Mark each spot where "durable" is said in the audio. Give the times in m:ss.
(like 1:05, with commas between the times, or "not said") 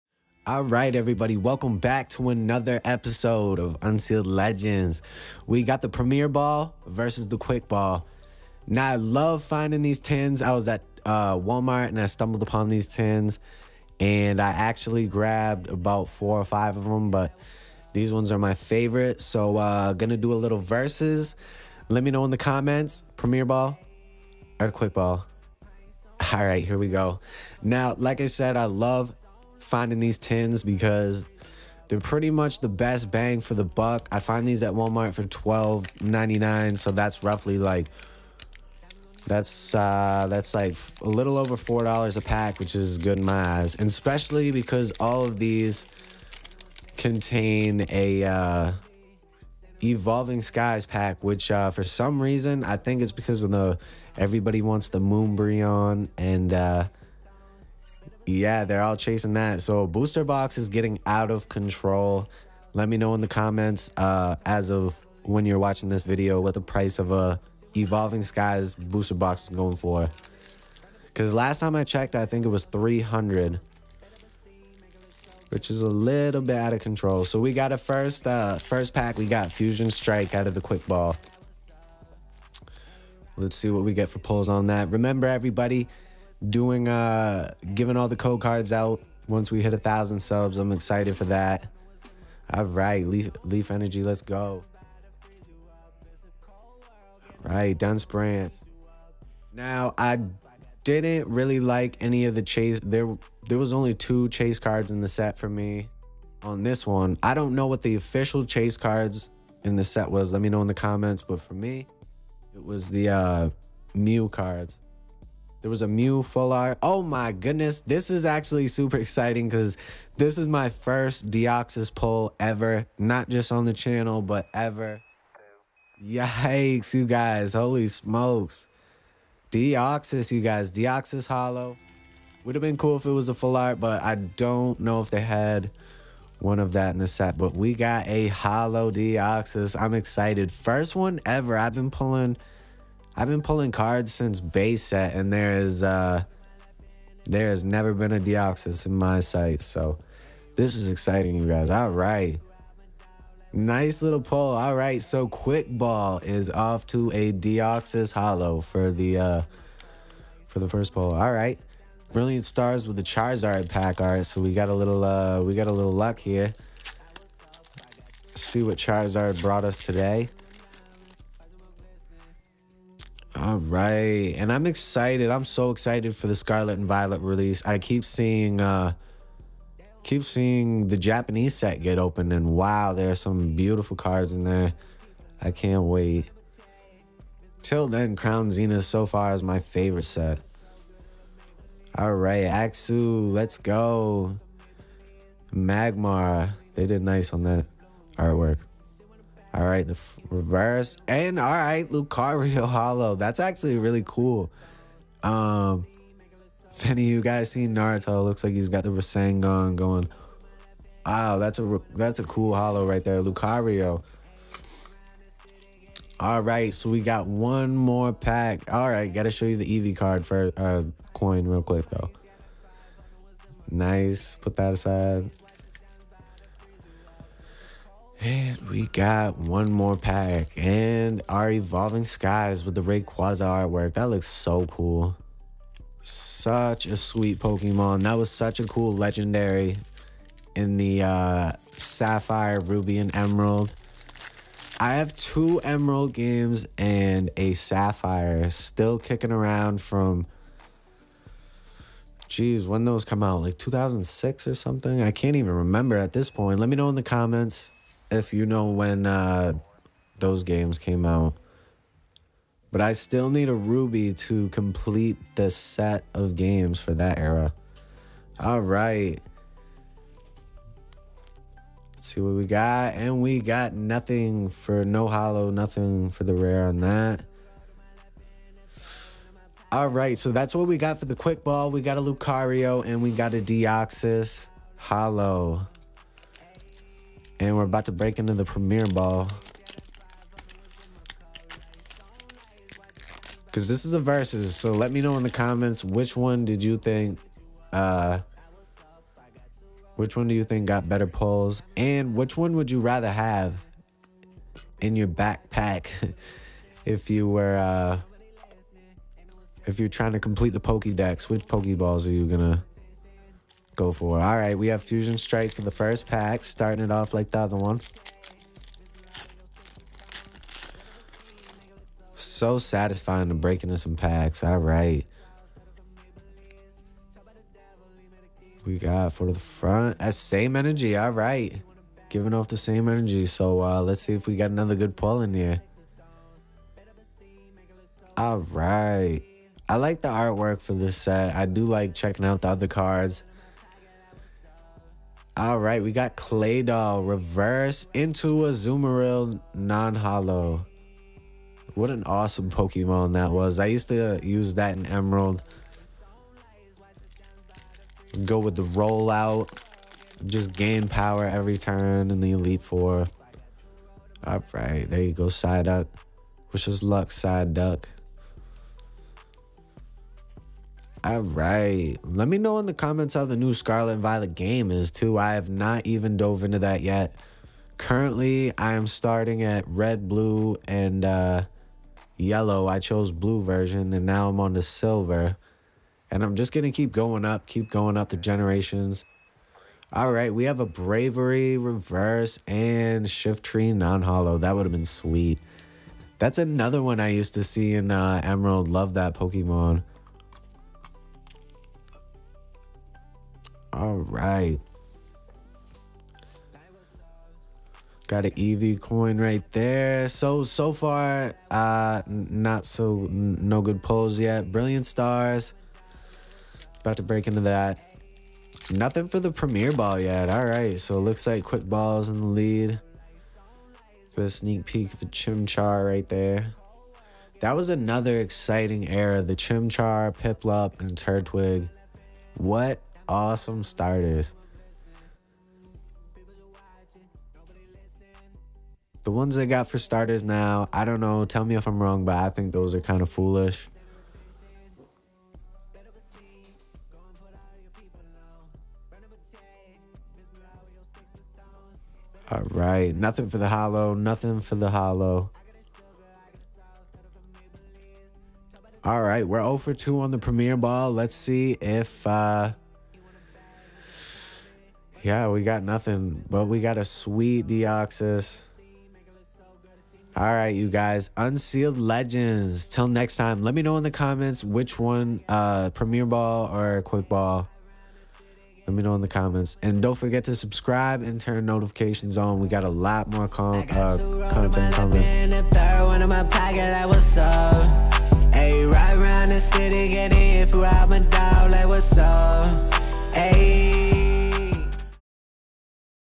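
not said.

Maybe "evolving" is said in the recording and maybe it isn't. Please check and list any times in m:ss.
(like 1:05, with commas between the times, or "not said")
0:49, 1:07, 3:51.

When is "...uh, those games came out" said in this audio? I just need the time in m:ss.
4:19.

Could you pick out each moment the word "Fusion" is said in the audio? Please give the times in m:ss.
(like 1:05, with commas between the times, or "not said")
1:19, 5:14.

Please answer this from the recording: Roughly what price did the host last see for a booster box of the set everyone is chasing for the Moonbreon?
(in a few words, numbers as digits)
300.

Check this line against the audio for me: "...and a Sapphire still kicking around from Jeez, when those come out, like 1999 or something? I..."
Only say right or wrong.
wrong.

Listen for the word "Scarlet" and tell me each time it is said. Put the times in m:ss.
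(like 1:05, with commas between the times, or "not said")
2:56, 6:13.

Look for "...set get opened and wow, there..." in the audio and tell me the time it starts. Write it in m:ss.
3:01.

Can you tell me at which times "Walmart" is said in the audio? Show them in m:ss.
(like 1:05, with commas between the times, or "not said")
0:11, 0:34.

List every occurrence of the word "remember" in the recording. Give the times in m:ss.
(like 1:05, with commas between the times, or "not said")
1:24, 4:15.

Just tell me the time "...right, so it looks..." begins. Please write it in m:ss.
7:00.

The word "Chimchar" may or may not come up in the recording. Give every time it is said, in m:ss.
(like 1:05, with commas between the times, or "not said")
7:05, 7:09.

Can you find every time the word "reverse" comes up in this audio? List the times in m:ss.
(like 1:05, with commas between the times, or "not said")
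3:20, 5:47, 6:31.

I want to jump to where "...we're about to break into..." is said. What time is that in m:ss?
4:47.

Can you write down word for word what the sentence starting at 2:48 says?
see what Charizard brought us today.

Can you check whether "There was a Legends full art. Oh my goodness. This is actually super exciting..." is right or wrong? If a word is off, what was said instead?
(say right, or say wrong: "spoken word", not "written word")
wrong: "Mew", not "Legends".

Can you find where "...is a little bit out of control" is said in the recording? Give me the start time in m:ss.
1:15.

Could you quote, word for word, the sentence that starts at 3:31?
Wow, that's a that's a cool hollow right there, Lucario.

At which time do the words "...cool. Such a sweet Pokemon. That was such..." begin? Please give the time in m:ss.
3:54.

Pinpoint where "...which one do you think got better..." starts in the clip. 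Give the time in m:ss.
4:59.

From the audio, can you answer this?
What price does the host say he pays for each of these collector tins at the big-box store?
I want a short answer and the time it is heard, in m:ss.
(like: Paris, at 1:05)
$12.99, at 0:35.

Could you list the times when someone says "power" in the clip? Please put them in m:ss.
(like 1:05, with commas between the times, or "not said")
6:00.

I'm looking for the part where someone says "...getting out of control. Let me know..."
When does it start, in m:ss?
1:00.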